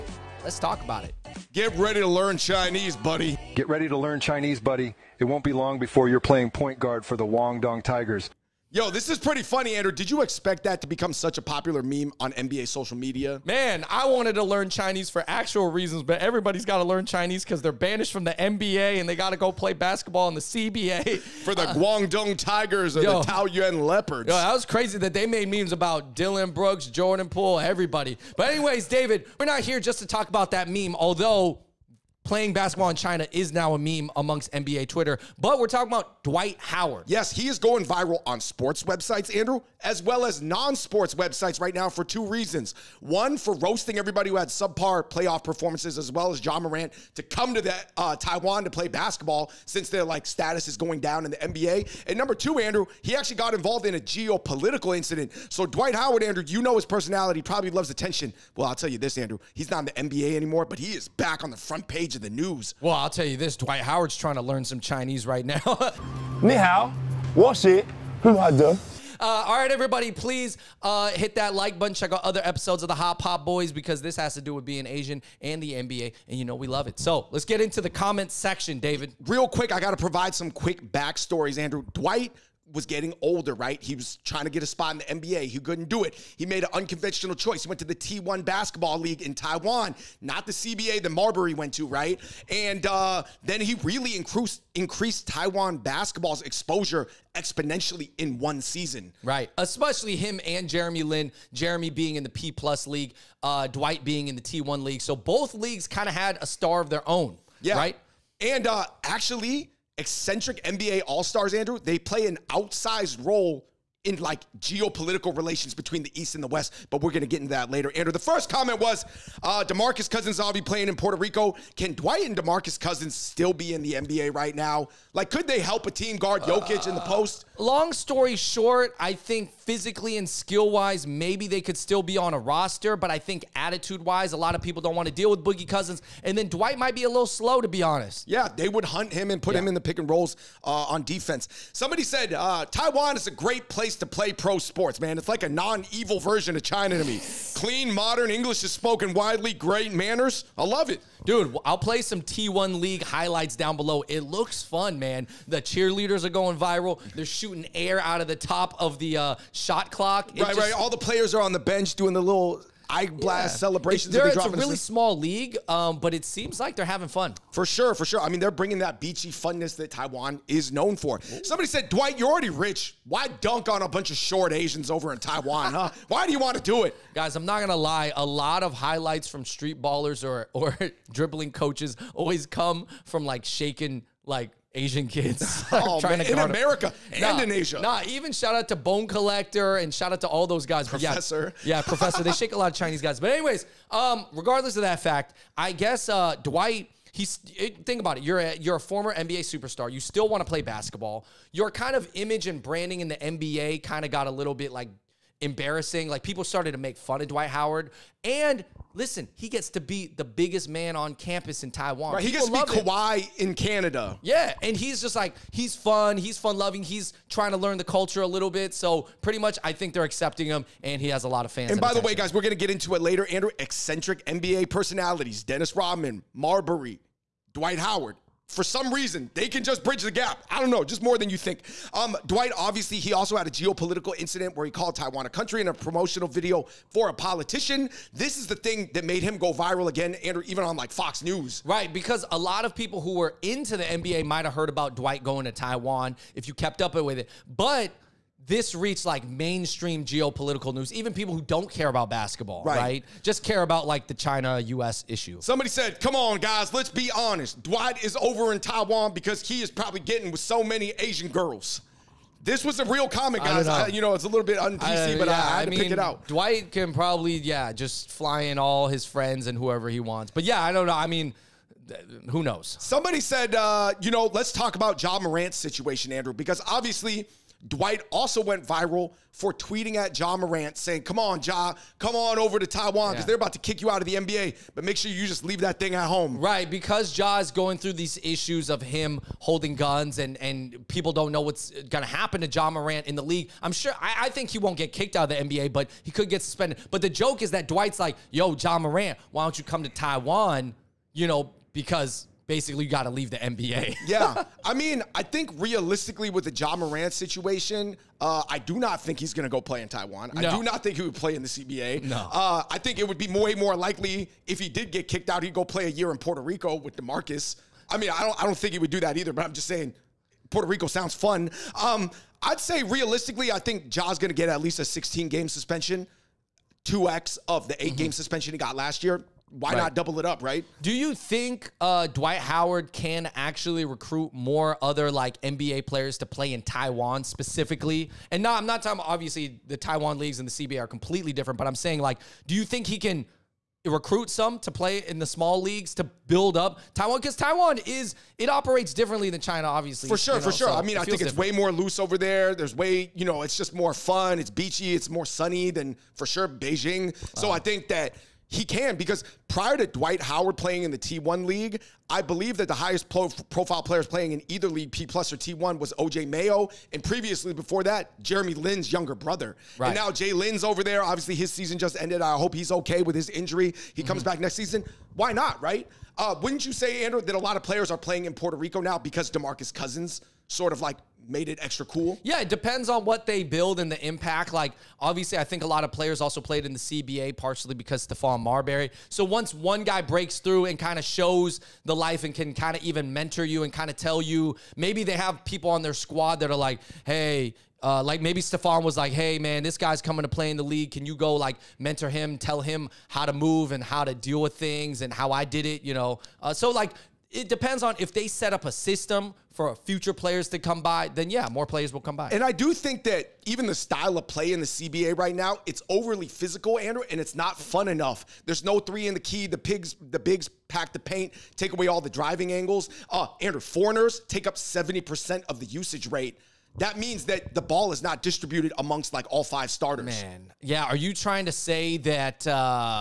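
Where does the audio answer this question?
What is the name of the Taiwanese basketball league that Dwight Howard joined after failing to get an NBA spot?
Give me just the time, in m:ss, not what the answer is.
1:27.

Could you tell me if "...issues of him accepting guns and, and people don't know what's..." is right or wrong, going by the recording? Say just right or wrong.
wrong.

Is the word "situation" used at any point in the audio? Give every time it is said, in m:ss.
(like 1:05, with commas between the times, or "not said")
4:35, 5:07.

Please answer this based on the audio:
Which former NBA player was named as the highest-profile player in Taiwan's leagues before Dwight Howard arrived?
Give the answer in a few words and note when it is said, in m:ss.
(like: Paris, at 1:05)
OJ Mayo, at 6:05.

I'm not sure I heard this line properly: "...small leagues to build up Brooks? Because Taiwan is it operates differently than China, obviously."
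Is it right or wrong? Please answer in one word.
wrong.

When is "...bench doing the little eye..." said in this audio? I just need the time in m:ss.
2:41.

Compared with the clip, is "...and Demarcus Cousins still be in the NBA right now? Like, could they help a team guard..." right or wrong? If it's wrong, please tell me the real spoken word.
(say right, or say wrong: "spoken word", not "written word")
right.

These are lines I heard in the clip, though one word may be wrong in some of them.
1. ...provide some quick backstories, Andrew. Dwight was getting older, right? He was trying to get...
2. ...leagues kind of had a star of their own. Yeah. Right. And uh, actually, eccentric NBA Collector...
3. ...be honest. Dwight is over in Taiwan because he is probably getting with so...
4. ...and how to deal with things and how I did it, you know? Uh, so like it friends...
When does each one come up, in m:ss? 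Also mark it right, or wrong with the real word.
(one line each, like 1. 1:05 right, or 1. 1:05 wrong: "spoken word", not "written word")
1. 1:19 right
2. 1:45 wrong: "All", not "Collector"
3. 4:16 right
4. 6:43 wrong: "depends", not "friends".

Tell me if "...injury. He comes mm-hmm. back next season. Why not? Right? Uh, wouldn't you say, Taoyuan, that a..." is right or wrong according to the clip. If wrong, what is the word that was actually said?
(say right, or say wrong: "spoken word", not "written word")
wrong: "Andrew", not "Taoyuan".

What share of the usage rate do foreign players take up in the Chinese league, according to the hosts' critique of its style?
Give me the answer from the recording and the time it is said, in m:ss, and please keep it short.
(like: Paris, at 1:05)
70%, at 7:04.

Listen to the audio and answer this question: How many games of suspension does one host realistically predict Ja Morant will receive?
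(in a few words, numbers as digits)
16.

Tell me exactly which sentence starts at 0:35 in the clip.
But we're talking about Dwight Howard.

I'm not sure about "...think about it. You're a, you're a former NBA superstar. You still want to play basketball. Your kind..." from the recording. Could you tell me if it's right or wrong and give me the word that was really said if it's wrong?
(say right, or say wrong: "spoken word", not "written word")
right.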